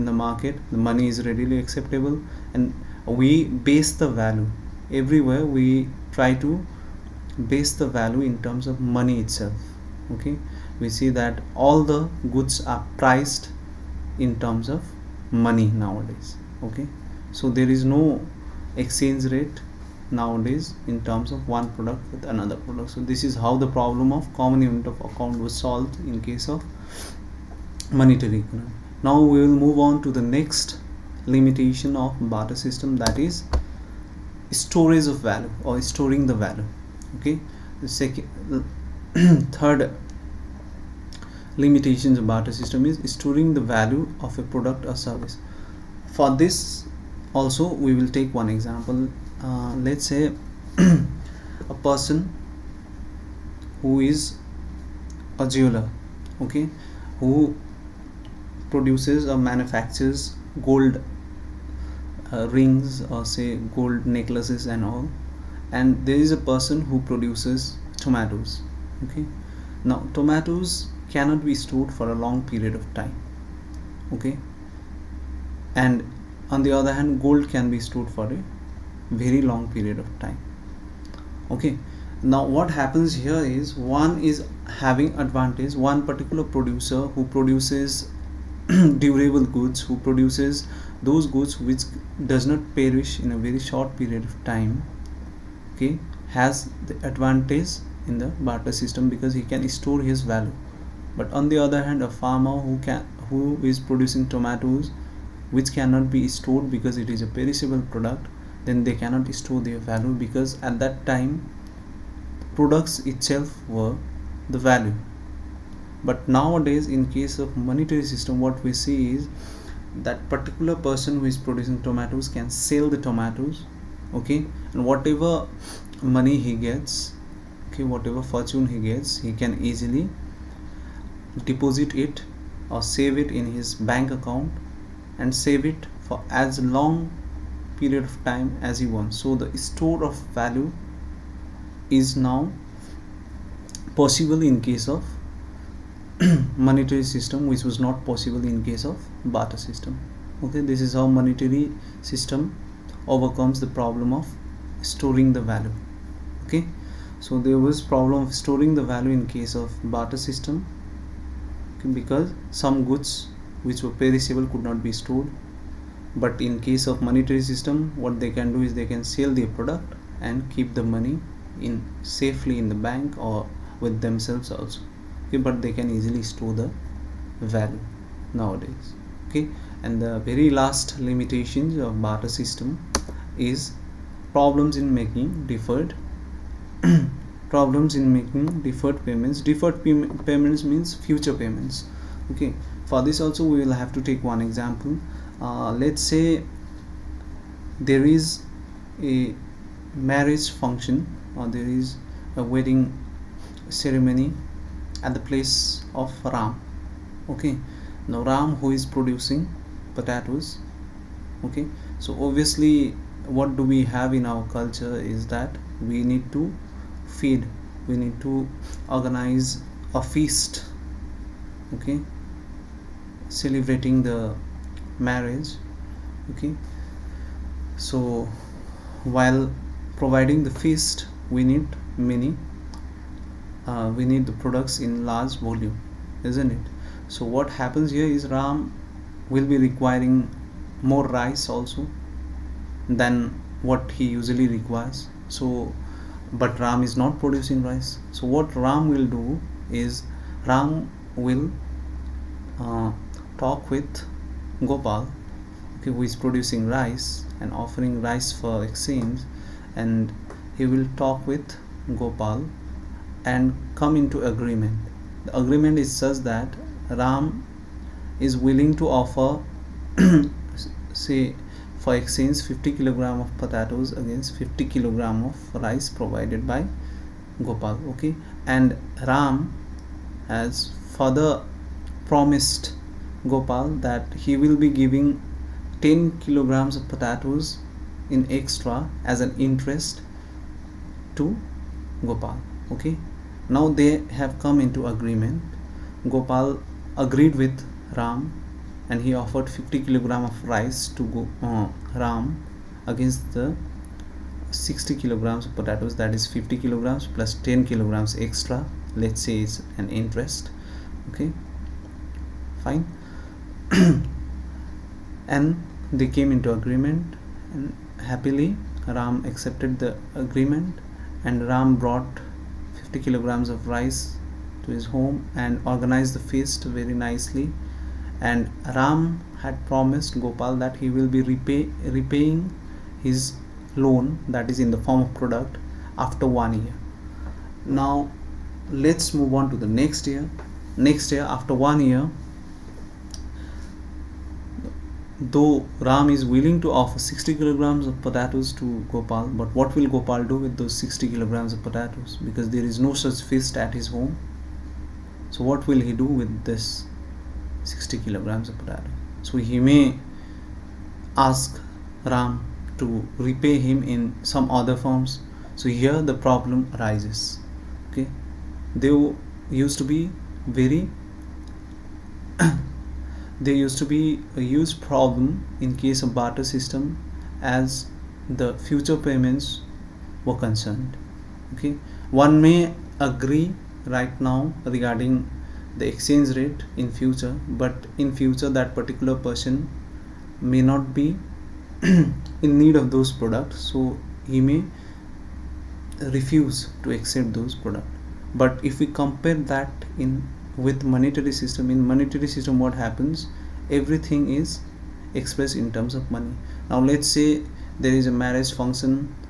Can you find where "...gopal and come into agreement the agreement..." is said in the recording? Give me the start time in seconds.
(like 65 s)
261 s.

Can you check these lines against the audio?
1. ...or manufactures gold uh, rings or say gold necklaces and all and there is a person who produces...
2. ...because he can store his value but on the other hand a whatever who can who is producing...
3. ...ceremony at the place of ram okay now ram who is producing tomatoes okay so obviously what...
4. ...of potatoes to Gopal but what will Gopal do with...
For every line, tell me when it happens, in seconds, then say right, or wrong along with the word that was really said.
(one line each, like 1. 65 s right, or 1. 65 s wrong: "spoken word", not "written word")
1. 59 s right
2. 99 s wrong: "farmer", not "whatever"
3. 203 s wrong: "potatoes", not "tomatoes"
4. 347 s right.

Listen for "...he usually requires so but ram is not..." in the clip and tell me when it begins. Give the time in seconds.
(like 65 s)
244 s.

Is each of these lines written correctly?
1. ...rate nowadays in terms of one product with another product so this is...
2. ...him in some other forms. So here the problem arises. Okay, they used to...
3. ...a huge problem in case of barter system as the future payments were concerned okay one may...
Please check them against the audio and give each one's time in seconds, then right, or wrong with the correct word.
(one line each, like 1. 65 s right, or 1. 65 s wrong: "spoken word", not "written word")
1. 19 s right
2. 363 s right
3. 374 s right.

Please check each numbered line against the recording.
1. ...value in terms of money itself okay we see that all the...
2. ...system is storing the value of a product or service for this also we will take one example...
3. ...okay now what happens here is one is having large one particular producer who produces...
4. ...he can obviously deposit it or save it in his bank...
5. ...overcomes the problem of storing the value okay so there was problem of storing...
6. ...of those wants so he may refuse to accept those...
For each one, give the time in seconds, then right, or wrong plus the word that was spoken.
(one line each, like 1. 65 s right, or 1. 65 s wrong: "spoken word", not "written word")
1. 7 s right
2. 42 s right
3. 81 s wrong: "advantage", not "large"
4. 129 s wrong: "easily", not "obviously"
5. 153 s right
6. 392 s wrong: "products", not "wants".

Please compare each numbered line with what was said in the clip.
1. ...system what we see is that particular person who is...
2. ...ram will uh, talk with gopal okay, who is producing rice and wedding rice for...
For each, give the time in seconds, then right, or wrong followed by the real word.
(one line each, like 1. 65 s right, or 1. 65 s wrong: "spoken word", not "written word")
1. 118 s right
2. 250 s wrong: "offering", not "wedding".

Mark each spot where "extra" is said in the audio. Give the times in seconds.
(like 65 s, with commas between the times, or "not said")
288 s, 308 s.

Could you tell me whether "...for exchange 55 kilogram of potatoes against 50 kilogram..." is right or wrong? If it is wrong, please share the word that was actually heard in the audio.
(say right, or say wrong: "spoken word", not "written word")
wrong: "50", not "55".